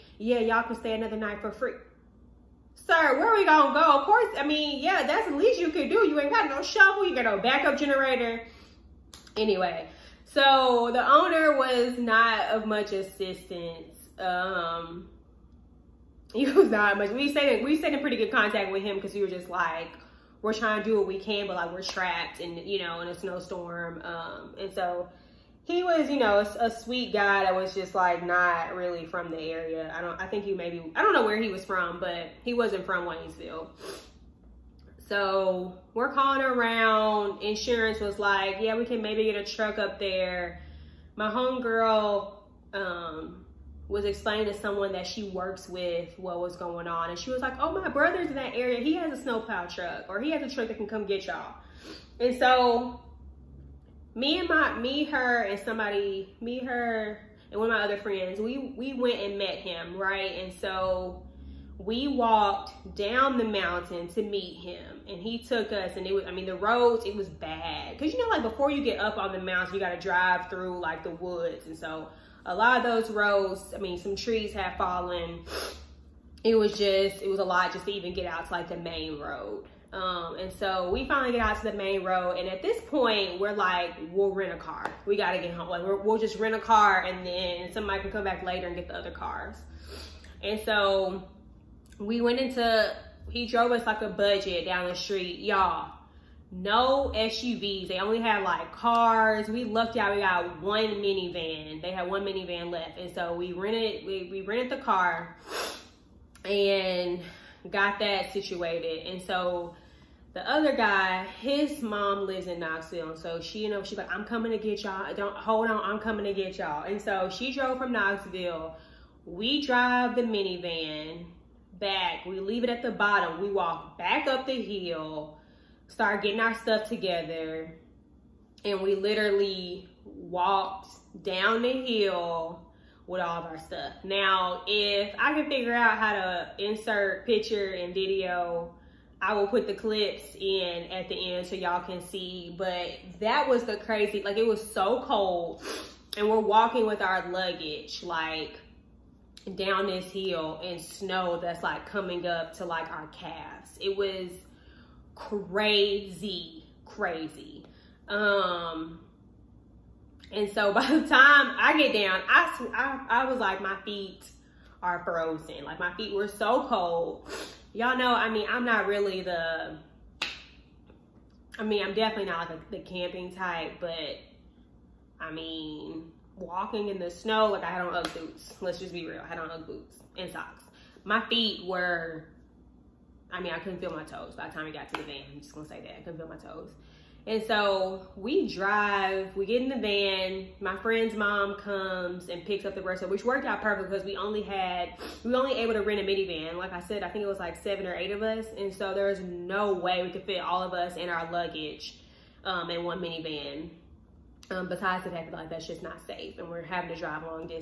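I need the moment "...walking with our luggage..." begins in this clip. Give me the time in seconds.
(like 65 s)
146 s.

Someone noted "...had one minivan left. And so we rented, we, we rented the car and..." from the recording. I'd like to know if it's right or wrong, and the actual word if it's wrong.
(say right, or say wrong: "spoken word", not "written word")
right.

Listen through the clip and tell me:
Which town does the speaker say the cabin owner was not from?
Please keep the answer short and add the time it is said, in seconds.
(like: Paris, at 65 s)
Waynesville, at 33 s.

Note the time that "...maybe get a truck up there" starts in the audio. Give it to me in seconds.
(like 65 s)
39 s.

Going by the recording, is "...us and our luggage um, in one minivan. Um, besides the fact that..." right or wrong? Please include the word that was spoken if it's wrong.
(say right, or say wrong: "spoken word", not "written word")
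right.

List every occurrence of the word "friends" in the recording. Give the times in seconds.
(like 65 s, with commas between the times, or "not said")
57 s, 190 s.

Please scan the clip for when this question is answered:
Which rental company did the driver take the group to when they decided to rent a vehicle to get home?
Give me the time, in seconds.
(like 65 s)
94 s.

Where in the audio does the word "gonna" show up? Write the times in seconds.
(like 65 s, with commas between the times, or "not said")
3 s, 185 s.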